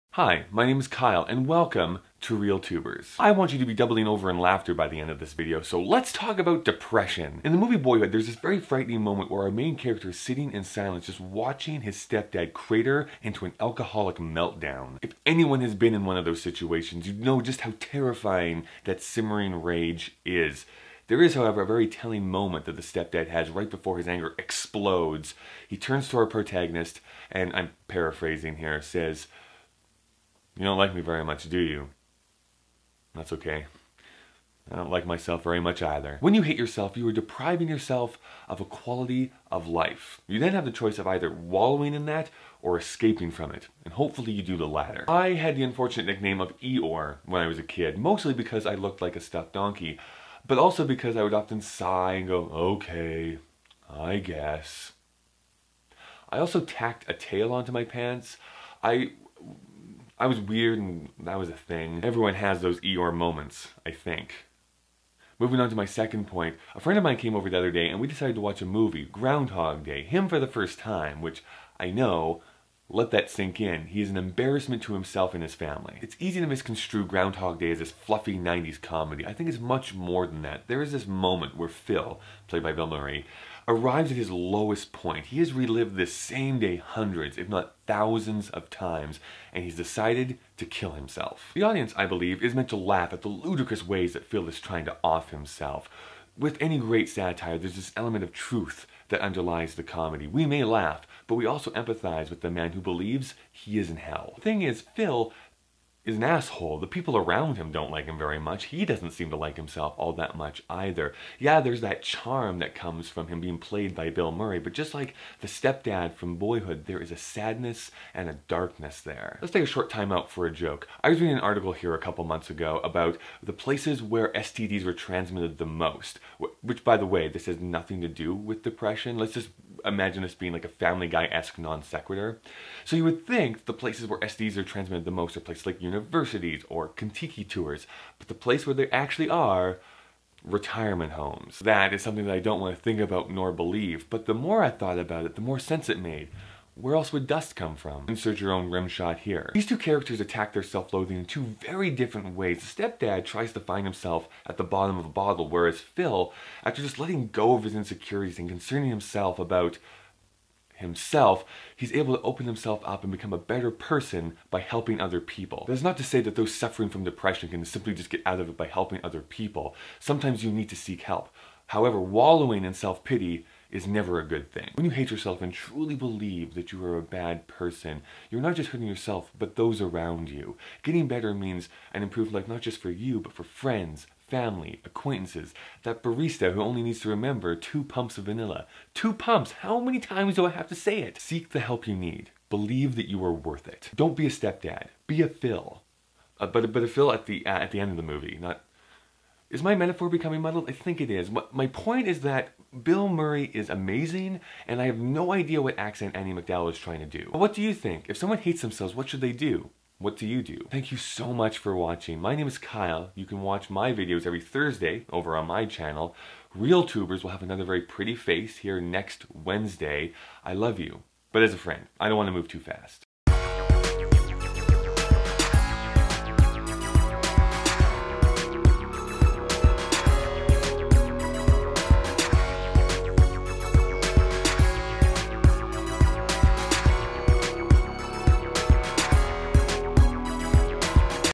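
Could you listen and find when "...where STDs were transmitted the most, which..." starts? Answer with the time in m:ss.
2:04.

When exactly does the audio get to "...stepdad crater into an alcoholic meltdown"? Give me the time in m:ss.
0:11.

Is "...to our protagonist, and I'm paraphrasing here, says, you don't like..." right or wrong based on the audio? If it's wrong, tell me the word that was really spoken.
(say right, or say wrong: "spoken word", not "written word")
right.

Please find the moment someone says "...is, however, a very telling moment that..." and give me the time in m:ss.
0:21.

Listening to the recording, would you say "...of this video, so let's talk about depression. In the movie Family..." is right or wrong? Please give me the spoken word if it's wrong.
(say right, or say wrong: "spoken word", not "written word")
wrong: "Boyhood", not "Family".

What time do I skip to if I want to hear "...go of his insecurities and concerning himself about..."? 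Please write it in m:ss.
2:37.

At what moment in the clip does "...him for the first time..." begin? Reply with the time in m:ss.
1:10.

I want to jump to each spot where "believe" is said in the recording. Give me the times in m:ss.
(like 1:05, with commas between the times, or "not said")
1:32, 1:42, 2:23, 2:55, 3:12.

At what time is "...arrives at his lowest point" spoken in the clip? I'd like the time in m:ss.
1:23.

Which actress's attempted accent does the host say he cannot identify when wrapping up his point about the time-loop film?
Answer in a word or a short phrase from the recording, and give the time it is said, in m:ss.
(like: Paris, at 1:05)
Andie MacDowell, at 3:26.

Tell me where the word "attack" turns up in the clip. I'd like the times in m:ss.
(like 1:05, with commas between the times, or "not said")
2:30.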